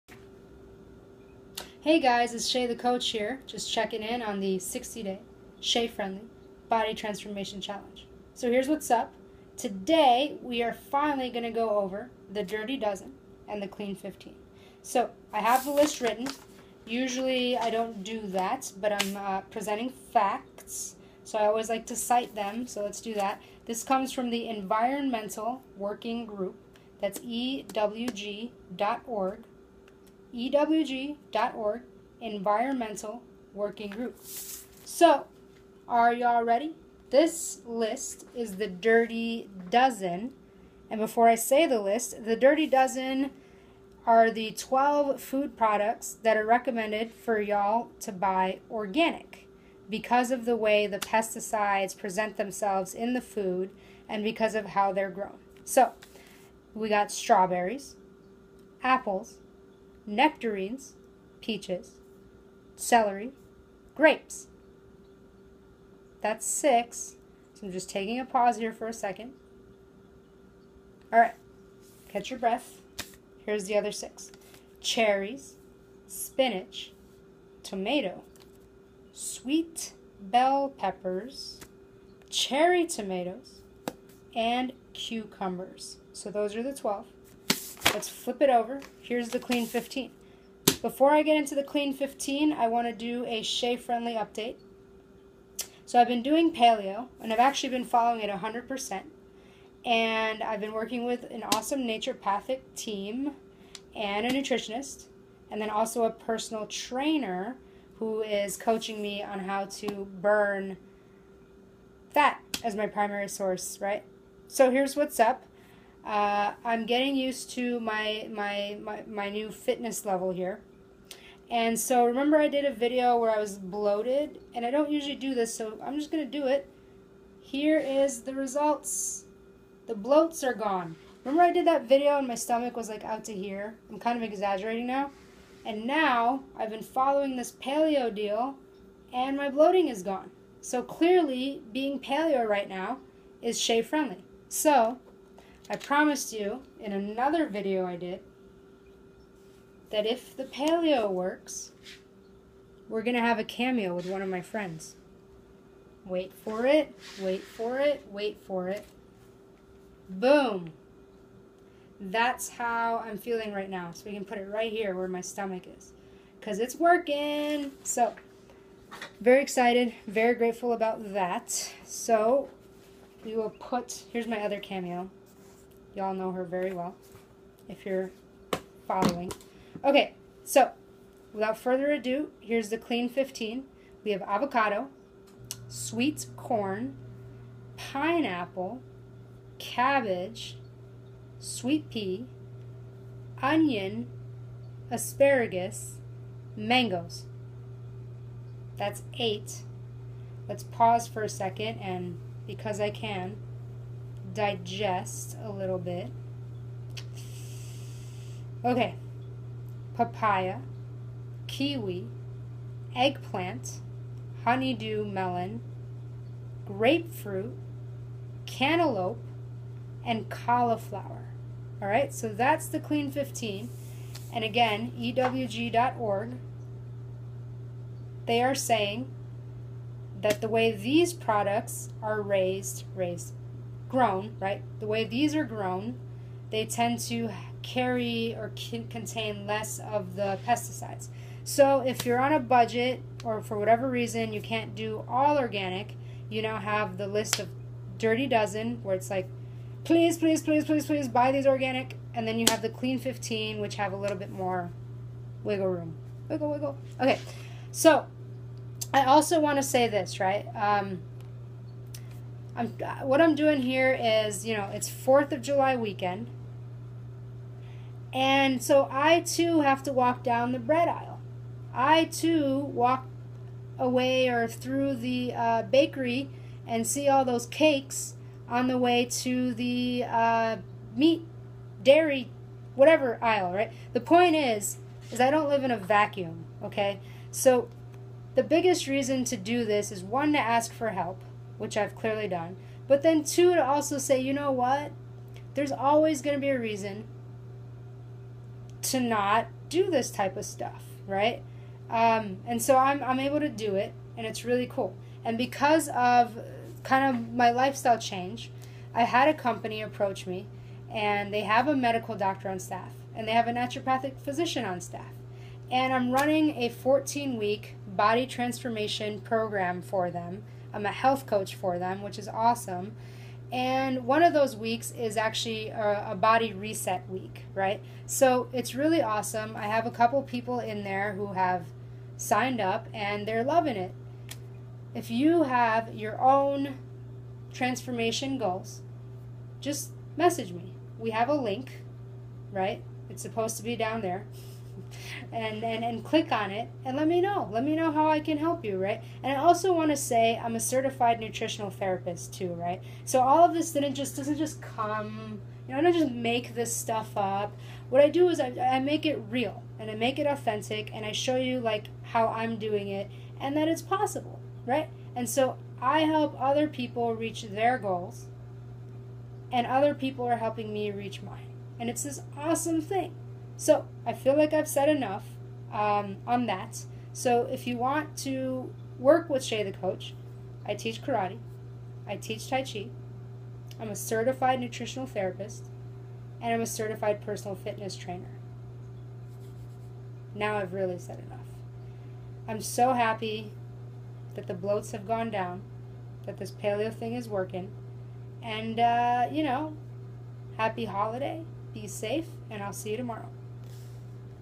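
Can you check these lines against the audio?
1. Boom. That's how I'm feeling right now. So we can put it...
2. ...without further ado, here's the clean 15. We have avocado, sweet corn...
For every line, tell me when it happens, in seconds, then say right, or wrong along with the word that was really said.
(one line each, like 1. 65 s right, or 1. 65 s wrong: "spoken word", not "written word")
1. 160 s right
2. 181 s right.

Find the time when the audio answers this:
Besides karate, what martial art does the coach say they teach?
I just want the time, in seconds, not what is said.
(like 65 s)
382 s.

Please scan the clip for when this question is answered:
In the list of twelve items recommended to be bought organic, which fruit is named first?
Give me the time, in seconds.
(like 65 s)
57 s.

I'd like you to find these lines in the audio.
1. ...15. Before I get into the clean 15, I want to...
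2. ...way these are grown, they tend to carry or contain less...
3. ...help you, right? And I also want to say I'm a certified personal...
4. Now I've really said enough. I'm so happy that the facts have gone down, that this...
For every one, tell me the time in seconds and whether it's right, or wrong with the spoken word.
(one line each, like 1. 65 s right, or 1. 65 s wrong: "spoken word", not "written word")
1. 89 s right
2. 234 s right
3. 348 s wrong: "nutritional", not "personal"
4. 390 s wrong: "bloats", not "facts".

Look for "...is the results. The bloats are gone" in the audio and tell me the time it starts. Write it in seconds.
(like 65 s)
127 s.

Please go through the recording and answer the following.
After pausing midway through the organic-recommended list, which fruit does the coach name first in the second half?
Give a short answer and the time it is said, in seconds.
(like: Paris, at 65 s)
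Cherries, at 74 s.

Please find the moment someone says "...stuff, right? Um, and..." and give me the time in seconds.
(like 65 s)
300 s.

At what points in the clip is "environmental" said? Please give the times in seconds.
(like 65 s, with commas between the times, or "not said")
24 s, 32 s.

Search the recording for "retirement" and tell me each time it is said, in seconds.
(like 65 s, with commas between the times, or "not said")
not said.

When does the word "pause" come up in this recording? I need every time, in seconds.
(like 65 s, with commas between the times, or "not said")
68 s, 200 s.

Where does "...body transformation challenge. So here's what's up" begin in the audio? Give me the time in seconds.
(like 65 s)
6 s.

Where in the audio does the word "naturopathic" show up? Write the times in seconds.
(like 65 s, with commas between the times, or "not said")
101 s, 313 s.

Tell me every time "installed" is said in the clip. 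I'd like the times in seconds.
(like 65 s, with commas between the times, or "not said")
not said.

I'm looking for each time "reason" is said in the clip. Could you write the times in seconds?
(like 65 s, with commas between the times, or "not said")
243 s, 288 s, 296 s.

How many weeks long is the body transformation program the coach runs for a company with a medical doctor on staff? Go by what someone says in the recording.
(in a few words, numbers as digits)
14.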